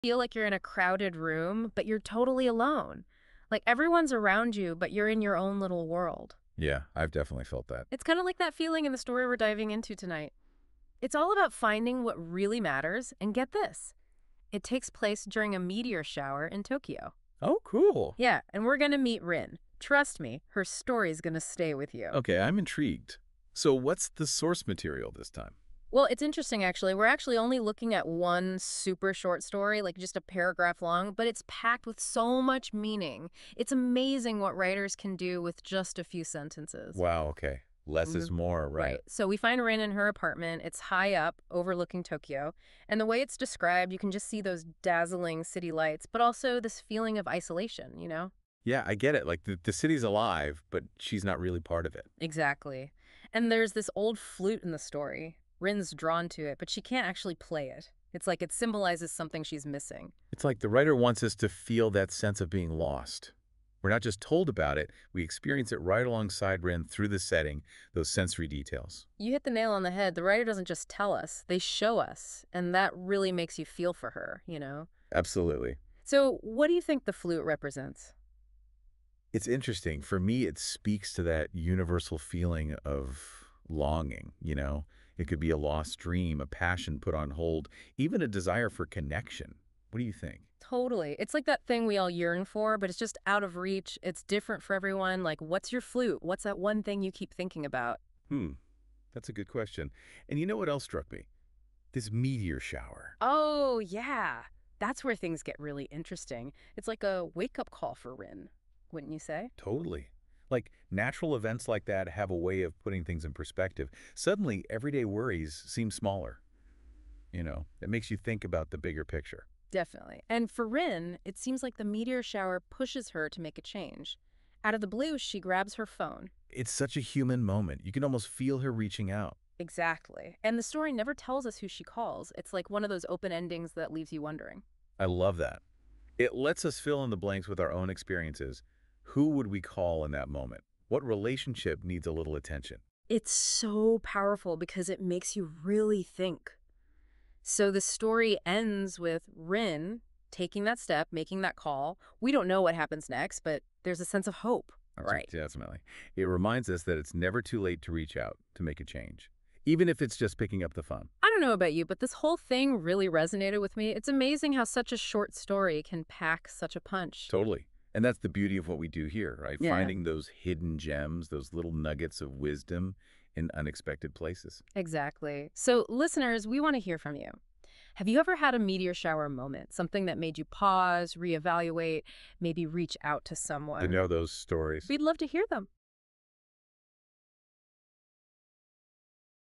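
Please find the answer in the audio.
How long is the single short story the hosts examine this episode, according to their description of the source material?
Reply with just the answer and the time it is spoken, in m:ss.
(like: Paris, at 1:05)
A paragraph, at 0:30.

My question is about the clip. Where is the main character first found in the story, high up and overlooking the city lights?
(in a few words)
Her apartment.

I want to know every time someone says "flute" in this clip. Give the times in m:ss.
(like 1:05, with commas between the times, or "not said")
0:54, 1:17, 1:35.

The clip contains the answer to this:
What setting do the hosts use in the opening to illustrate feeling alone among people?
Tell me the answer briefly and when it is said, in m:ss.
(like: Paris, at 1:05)
A crowded room, at 0:00.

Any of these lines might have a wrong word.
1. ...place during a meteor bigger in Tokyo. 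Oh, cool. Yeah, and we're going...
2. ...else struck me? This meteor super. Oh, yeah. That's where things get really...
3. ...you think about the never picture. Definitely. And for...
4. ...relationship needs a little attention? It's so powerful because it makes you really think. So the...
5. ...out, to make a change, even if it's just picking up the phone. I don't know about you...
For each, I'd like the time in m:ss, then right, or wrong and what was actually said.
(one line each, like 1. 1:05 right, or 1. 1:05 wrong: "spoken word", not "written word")
1. 0:14 wrong: "shower", not "bigger"
2. 1:40 wrong: "shower", not "super"
3. 1:58 wrong: "bigger", not "never"
4. 2:21 right
5. 2:38 right.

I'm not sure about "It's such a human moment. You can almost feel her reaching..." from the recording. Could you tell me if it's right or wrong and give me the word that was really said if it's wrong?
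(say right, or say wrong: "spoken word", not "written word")
right.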